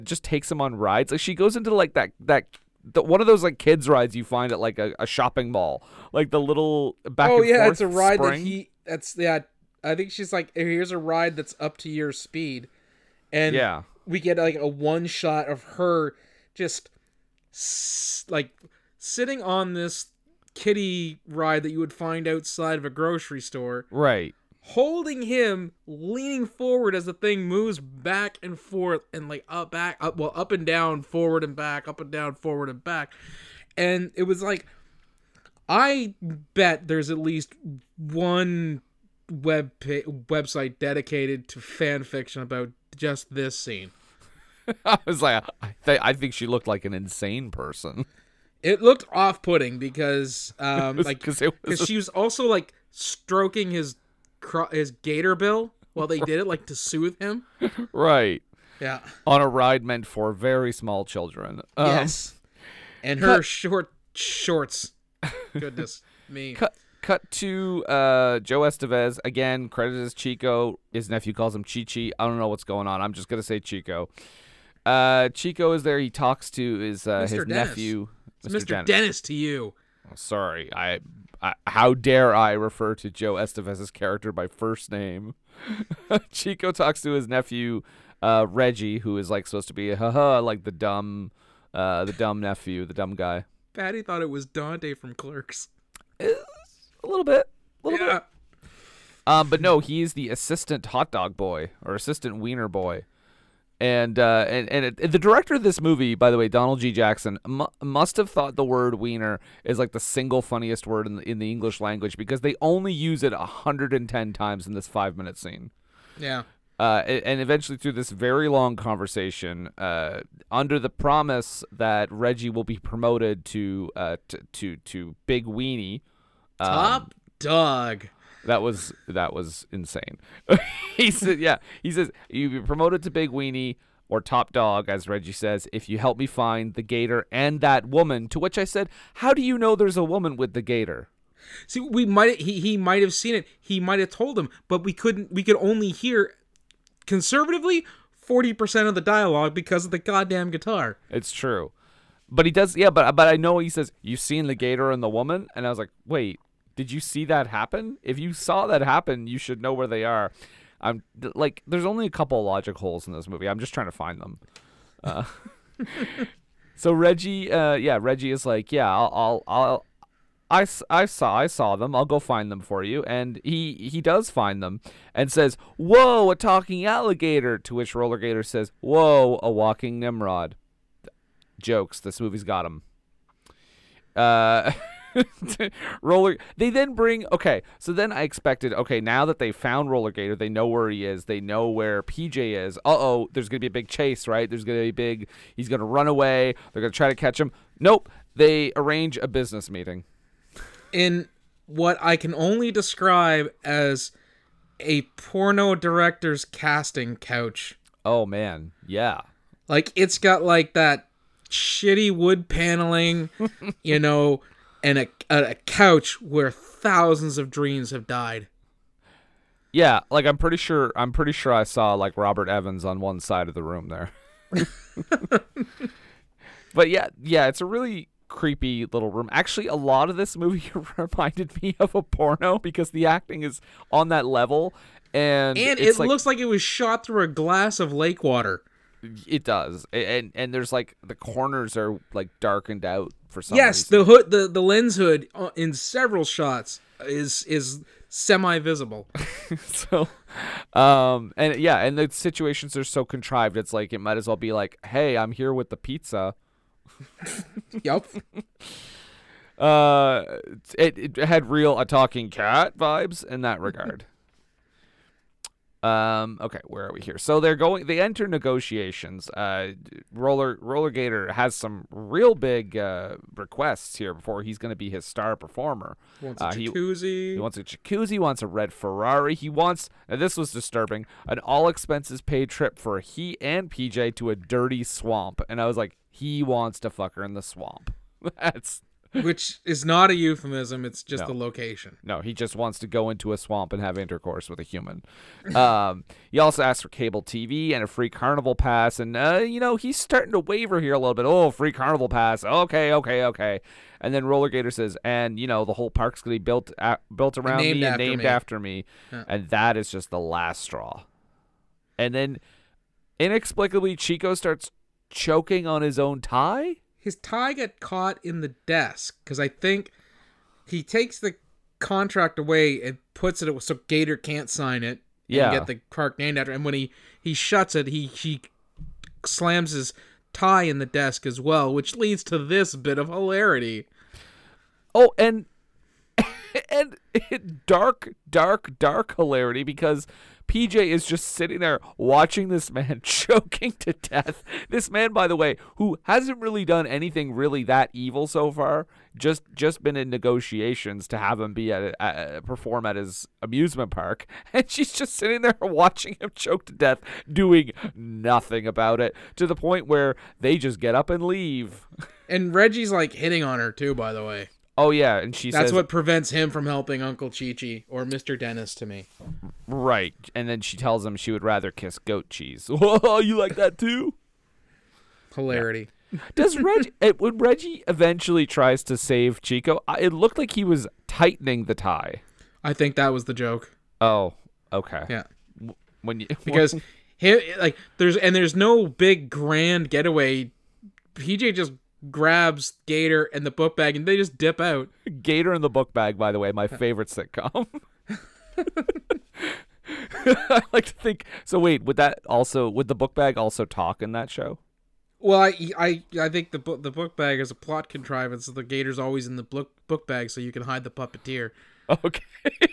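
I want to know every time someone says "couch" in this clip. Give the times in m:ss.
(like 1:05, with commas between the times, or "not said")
3:27, 3:35.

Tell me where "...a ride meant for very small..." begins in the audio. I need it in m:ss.
0:59.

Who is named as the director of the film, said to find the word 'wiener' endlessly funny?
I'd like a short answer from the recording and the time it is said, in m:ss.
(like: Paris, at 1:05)
Donald G. Jackson, at 1:46.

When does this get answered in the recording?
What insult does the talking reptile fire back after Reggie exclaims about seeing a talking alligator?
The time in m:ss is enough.
2:59.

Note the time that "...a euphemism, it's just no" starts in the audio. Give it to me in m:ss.
4:50.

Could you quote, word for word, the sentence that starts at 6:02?
And Reggie's like hitting on her too, by the way.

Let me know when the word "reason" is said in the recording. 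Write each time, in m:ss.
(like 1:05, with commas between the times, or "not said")
4:03.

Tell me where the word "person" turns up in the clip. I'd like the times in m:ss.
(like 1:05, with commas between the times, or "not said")
0:47.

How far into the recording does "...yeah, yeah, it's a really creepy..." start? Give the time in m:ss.
3:46.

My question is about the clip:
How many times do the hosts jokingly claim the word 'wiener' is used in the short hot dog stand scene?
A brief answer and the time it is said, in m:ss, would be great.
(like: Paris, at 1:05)
110, at 1:53.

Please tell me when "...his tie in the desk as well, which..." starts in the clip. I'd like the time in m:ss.
5:29.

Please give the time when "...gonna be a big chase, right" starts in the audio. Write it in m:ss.
3:13.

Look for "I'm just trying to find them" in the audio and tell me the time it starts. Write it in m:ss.
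2:43.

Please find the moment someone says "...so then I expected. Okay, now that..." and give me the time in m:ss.
3:07.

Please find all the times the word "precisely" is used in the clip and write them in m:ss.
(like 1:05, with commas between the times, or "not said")
not said.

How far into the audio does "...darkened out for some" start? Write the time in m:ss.
4:02.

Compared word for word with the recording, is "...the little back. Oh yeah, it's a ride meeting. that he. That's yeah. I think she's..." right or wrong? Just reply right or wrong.
wrong.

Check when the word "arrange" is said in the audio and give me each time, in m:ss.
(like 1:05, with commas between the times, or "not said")
3:18.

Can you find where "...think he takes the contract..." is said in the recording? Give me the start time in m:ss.
5:19.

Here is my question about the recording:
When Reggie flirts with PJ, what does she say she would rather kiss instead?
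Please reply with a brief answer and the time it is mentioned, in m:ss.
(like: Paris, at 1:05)
Goat cheese, at 6:11.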